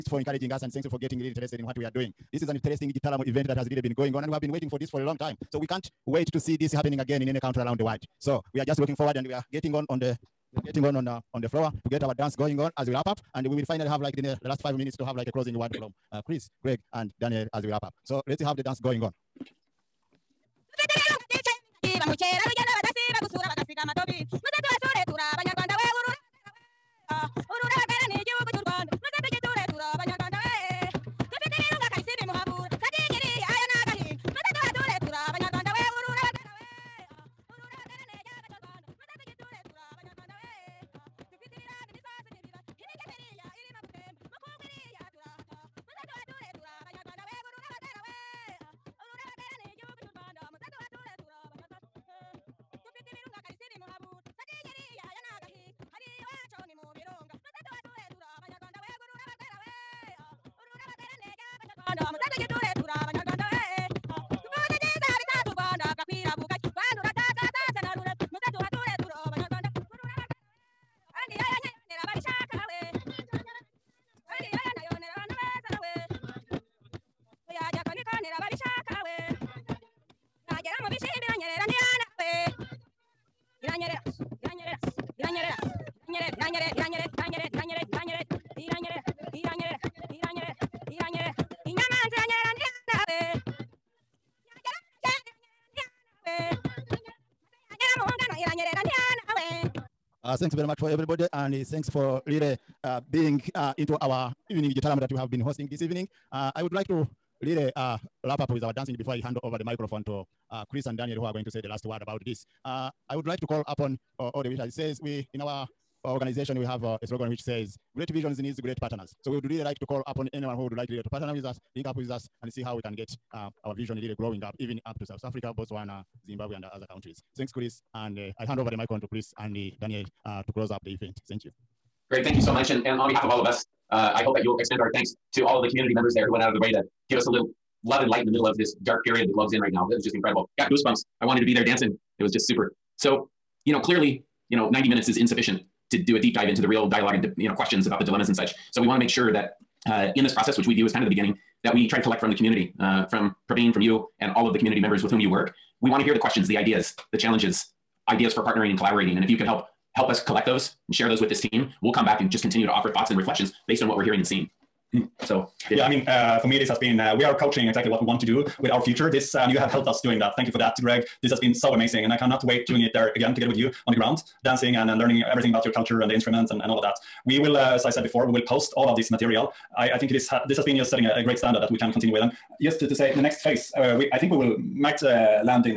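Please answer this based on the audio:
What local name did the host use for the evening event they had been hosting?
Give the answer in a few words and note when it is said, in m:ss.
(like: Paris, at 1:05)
igitaramo, at 1:44.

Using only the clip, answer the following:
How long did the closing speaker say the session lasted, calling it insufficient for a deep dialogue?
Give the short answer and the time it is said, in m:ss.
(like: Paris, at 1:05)
90 minutes, at 2:24.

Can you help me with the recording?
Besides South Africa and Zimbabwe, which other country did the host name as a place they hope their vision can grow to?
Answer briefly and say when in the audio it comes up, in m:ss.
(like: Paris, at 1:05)
Botswana, at 2:05.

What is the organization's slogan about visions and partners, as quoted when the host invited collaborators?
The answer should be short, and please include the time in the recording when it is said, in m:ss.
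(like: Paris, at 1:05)
Great visions needs great partners, at 1:57.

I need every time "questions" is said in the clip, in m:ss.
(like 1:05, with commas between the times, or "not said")
2:27, 2:36.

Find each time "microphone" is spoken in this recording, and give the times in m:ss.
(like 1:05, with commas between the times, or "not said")
1:49, 2:08.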